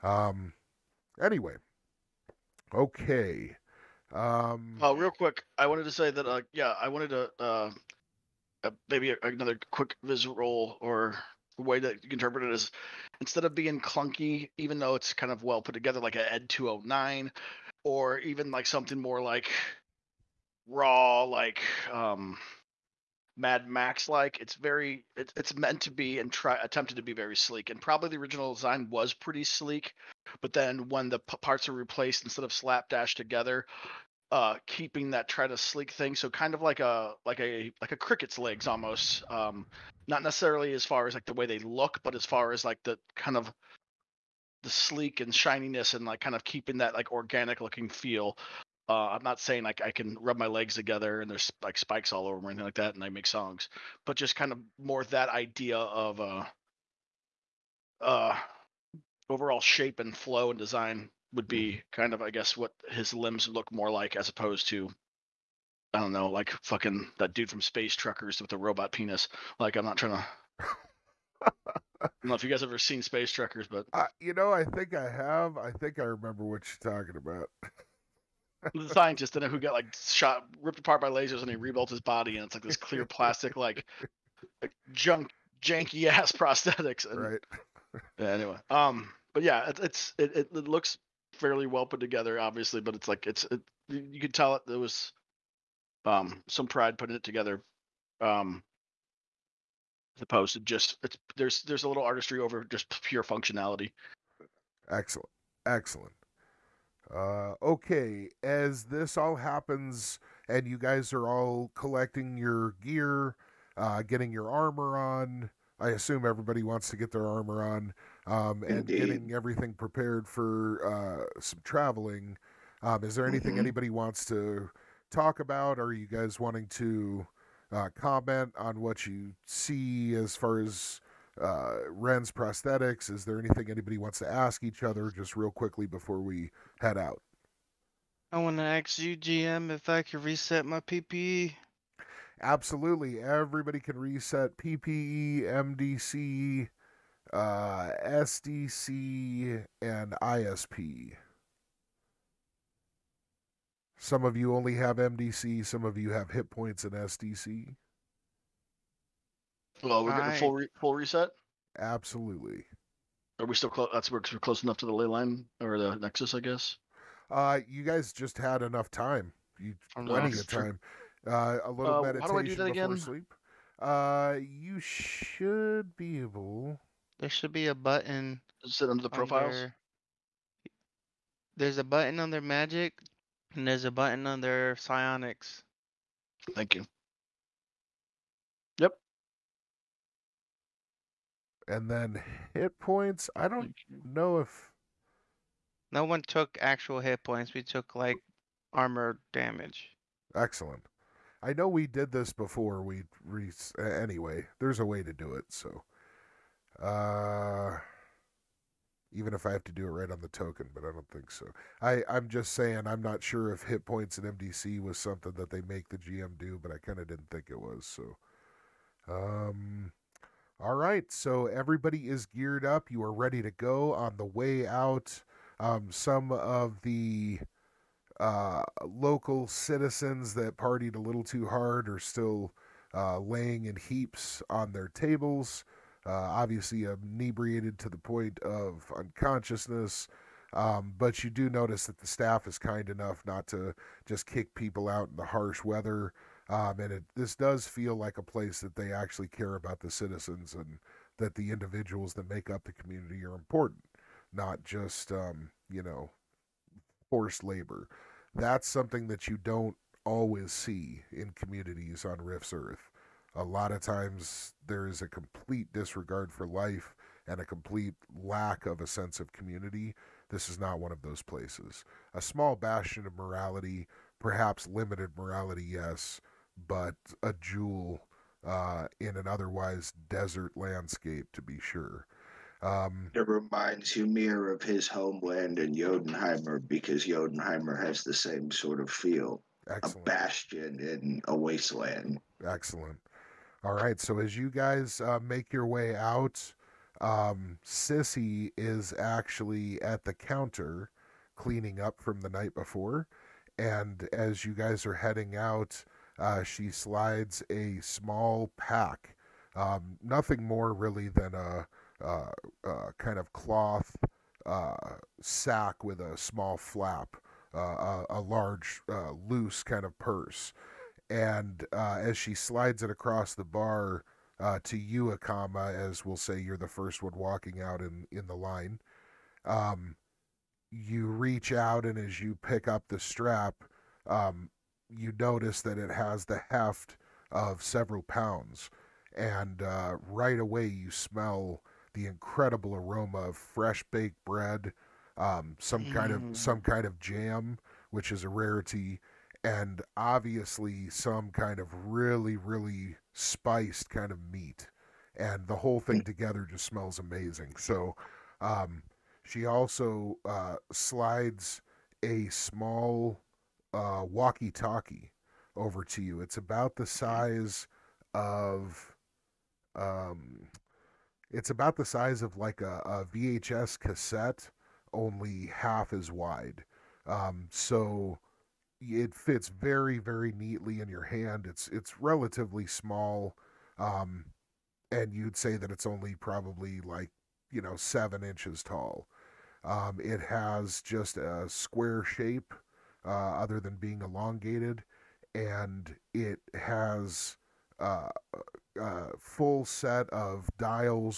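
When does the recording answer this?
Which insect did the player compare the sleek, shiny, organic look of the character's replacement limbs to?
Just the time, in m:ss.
0:37.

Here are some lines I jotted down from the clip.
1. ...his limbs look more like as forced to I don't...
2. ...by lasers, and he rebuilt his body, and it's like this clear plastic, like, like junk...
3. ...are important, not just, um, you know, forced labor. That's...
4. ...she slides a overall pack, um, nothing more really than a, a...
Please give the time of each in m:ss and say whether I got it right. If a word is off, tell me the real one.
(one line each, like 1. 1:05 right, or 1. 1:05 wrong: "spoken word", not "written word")
1. 1:02 wrong: "opposed", not "forced"
2. 1:21 right
3. 4:13 right
4. 5:06 wrong: "small", not "overall".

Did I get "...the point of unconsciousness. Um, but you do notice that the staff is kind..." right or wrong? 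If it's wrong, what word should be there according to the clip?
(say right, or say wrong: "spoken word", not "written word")
right.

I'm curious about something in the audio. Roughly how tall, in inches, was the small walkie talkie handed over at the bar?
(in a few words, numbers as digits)
7 inches.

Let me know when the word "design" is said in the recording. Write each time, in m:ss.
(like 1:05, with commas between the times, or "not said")
0:28, 1:00.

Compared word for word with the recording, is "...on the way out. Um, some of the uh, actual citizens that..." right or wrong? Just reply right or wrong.
wrong.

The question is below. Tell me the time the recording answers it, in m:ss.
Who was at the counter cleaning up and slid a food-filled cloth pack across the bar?
4:57.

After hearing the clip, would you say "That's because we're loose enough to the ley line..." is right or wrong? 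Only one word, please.
wrong.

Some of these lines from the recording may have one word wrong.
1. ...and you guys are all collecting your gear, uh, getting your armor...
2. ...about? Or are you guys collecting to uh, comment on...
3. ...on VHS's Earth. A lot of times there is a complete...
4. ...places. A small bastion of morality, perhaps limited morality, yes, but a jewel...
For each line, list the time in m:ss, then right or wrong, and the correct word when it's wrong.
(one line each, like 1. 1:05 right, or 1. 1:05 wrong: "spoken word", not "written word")
1. 1:50 right
2. 2:05 wrong: "wanting", not "collecting"
3. 4:22 wrong: "Rift", not "VHS"
4. 4:31 right.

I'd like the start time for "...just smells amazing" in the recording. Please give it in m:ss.
5:56.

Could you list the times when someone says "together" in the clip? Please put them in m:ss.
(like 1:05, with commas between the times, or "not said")
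0:15, 0:33, 0:50, 1:31, 1:37, 5:56.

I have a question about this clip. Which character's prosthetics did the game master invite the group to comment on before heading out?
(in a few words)
Ren.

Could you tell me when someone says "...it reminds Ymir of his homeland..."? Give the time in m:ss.
4:43.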